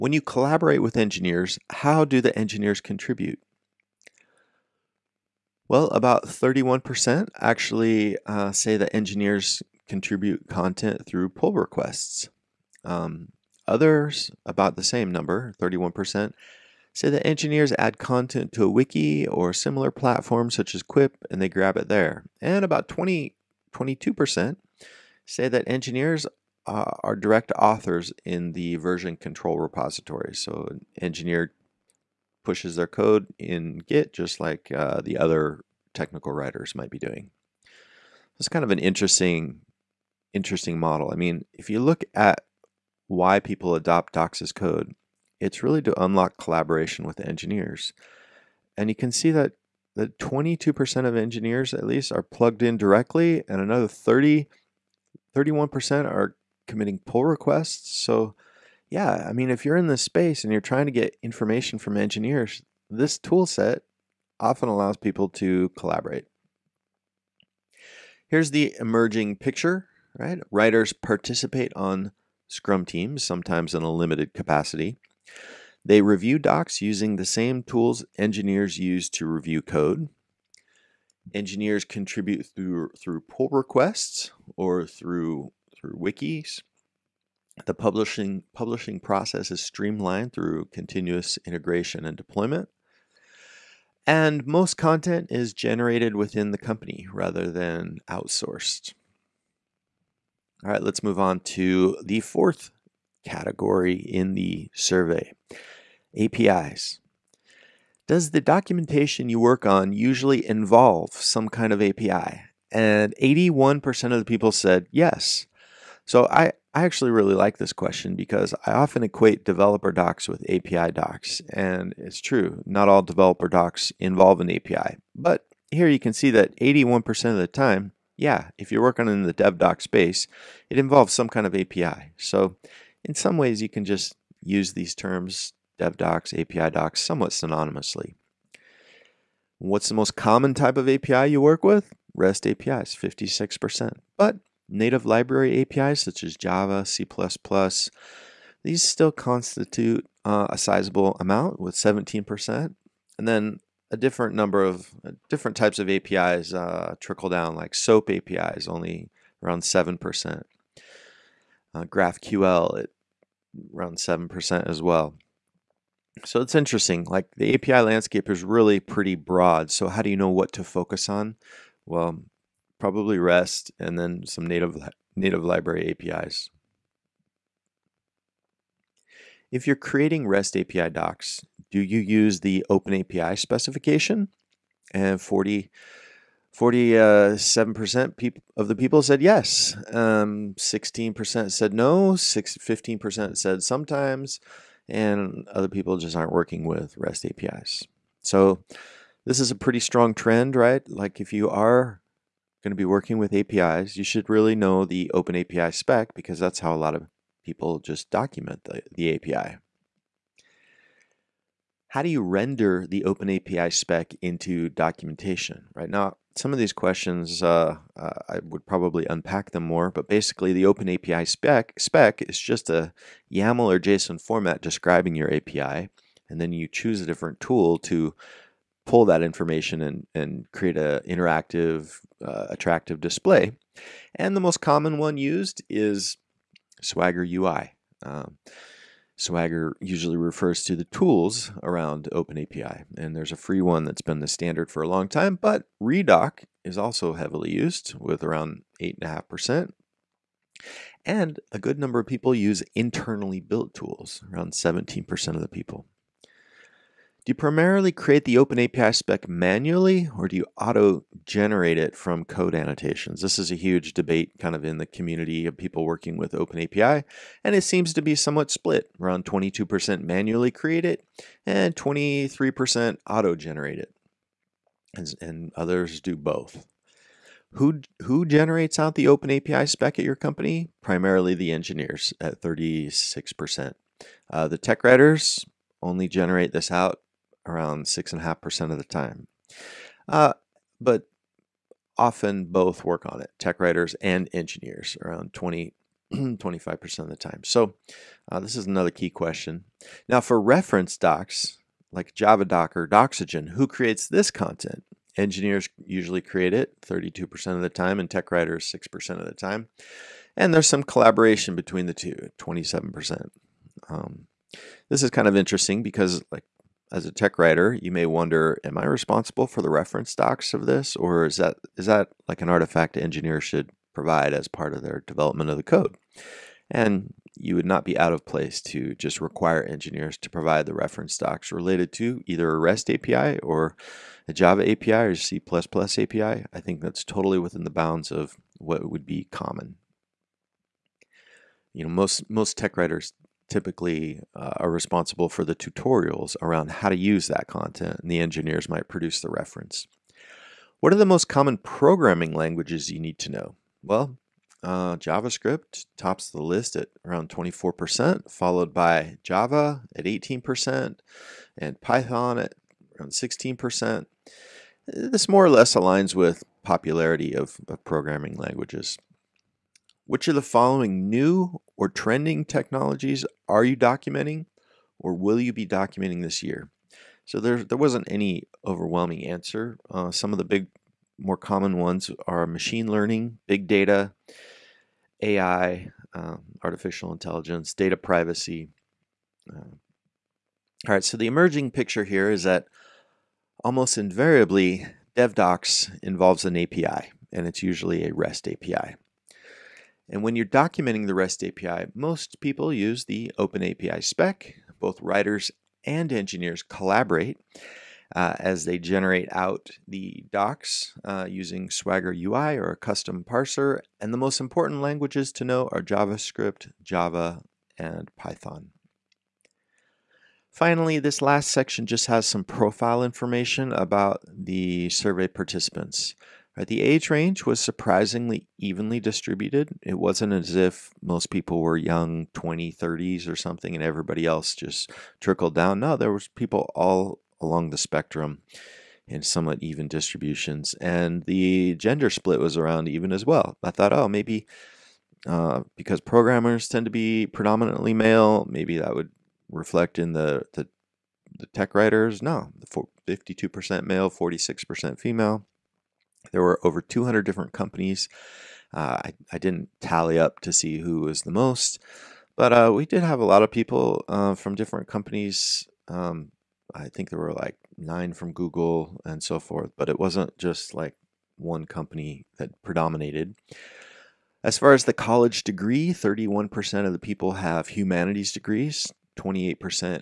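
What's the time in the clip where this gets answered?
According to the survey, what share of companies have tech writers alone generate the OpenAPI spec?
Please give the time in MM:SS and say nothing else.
04:47.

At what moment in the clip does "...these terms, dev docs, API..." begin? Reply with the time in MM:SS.
02:14.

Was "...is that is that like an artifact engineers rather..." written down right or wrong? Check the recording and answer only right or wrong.
wrong.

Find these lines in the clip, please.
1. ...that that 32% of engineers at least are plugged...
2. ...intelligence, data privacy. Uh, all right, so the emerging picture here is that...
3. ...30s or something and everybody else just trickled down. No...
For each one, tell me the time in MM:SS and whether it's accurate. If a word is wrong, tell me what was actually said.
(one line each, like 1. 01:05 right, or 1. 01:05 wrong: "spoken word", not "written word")
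1. 00:49 wrong: "22", not "32"
2. 06:27 right
3. 07:12 right.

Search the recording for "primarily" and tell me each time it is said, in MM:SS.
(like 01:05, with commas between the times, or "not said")
04:17, 04:40.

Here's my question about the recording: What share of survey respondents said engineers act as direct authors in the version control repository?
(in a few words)
22%.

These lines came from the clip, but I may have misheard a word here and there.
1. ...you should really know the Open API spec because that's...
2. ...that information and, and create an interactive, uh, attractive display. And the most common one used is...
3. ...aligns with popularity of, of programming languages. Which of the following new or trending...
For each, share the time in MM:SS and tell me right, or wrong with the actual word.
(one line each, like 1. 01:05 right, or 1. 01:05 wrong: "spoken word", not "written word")
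1. 03:23 right
2. 03:49 right
3. 06:05 right.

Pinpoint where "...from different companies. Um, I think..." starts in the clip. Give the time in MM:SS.
07:44.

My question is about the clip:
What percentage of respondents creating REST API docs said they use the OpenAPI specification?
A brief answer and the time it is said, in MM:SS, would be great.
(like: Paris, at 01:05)
47%, at 03:05.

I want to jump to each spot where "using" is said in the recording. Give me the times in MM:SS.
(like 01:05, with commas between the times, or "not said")
01:16, 06:51.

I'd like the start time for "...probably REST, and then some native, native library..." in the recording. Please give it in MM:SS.
02:52.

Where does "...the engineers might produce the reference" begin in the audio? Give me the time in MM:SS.
05:48.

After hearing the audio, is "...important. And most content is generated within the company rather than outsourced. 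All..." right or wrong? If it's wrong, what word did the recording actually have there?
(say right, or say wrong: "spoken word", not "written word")
wrong: "deployment", not "important".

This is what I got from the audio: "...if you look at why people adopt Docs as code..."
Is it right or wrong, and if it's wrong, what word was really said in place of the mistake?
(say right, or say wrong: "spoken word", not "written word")
right.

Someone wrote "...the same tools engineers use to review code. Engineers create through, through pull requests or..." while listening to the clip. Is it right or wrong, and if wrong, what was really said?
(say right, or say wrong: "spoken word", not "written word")
wrong: "contribute", not "create".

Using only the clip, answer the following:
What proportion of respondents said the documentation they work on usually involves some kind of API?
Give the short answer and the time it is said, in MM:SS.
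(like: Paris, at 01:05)
81%, at 01:53.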